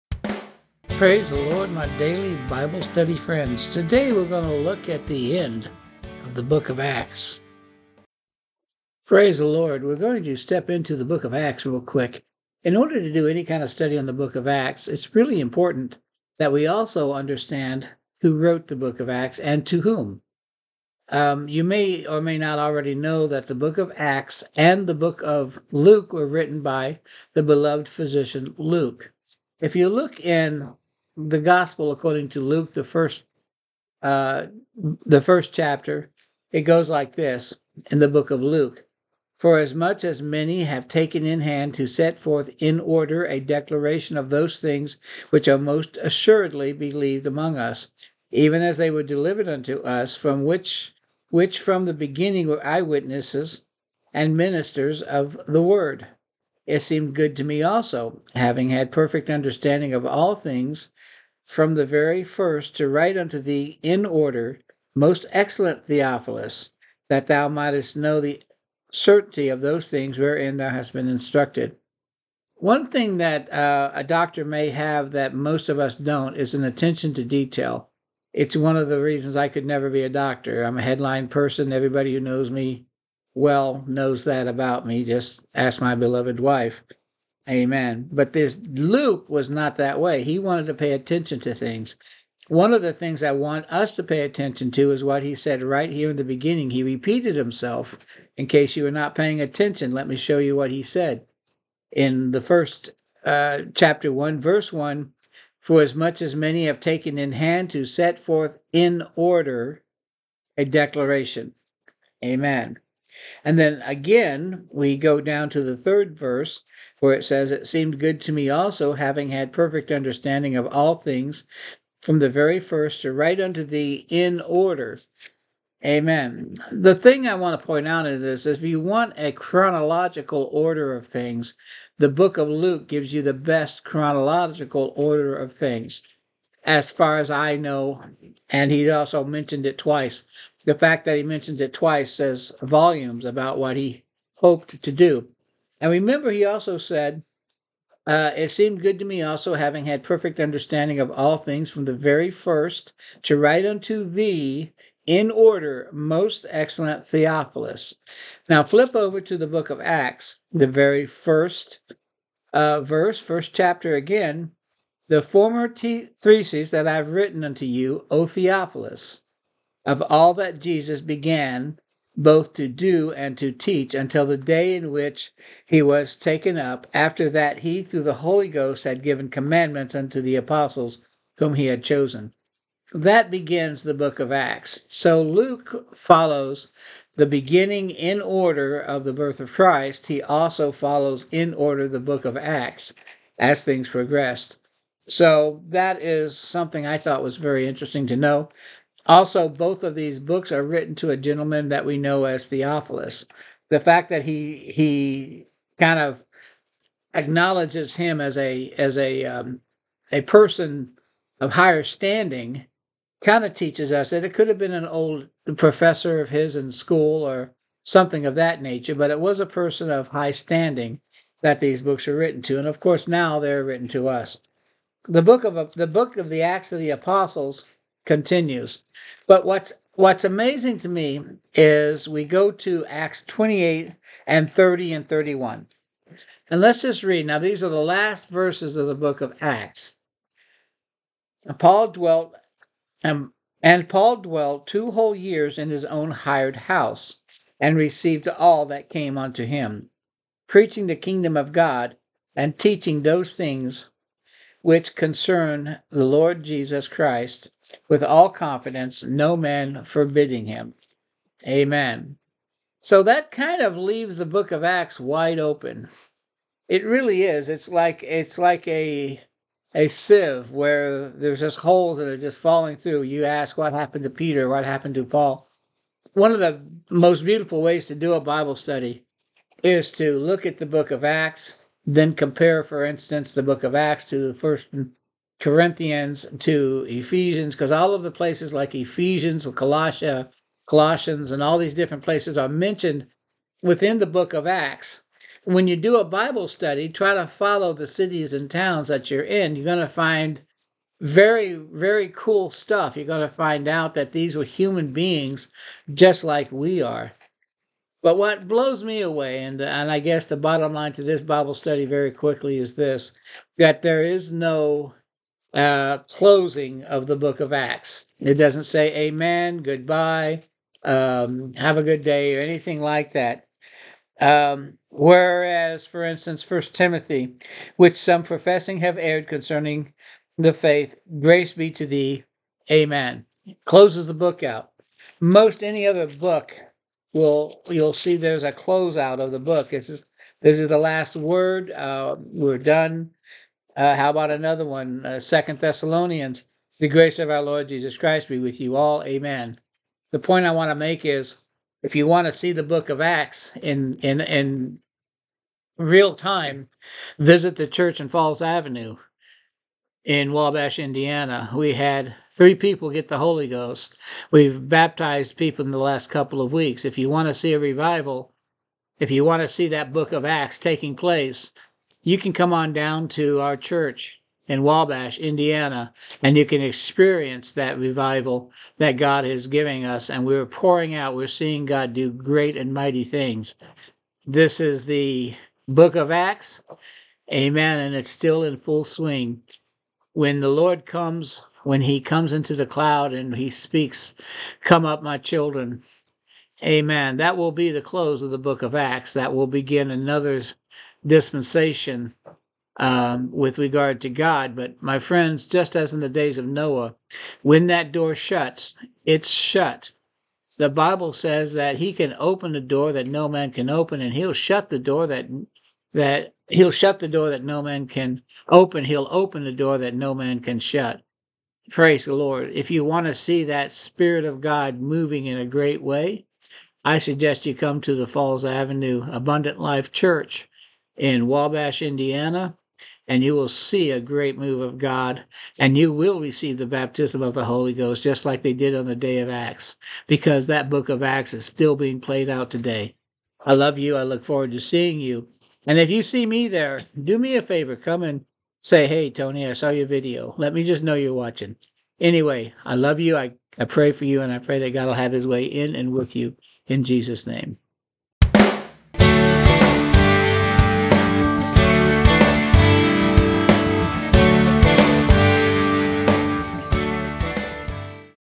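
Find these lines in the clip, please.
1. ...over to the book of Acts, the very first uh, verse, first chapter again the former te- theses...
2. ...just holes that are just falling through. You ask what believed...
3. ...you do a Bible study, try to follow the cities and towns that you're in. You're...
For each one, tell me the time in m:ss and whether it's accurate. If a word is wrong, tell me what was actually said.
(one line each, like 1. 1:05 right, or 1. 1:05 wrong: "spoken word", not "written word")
1. 2:38 right
2. 4:31 wrong: "happened", not "believed"
3. 4:55 right.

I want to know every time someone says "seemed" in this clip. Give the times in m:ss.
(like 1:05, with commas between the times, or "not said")
0:56, 1:57, 2:28.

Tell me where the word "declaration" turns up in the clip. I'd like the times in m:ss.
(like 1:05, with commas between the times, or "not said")
0:43, 1:50.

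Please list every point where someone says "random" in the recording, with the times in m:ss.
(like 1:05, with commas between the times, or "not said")
not said.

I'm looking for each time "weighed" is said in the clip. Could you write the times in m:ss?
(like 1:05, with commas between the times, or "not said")
not said.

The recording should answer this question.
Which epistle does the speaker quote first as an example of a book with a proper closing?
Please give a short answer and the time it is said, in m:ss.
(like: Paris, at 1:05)
First Timothy, at 5:26.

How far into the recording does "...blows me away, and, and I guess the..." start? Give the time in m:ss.
5:08.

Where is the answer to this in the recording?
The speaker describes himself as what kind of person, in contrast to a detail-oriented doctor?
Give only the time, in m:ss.
1:20.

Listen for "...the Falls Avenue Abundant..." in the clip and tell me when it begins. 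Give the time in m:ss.
7:07.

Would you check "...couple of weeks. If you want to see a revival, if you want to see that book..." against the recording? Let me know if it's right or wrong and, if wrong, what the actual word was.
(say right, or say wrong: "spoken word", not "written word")
right.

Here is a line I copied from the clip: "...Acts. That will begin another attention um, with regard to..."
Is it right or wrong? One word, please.
wrong.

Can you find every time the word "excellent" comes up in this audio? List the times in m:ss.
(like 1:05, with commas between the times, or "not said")
1:05, 2:36.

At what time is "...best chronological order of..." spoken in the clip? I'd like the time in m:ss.
2:13.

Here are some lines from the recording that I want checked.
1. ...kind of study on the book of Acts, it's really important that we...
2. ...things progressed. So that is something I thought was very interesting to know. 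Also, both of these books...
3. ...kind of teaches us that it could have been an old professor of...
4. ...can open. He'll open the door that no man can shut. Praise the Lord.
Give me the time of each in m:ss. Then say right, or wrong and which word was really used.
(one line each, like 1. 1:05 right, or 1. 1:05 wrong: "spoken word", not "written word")
1. 0:13 right
2. 3:13 right
3. 3:33 right
4. 6:57 right.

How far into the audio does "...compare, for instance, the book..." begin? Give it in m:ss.
4:42.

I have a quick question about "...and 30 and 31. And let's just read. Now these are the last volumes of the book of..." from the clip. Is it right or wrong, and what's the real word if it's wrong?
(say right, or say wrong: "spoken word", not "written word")
wrong: "verses", not "volumes".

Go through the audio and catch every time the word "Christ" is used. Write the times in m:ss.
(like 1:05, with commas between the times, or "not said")
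3:09, 4:16, 5:47.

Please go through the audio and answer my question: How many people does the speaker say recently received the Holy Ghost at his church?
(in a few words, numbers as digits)
3.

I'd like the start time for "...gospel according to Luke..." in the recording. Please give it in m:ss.
0:31.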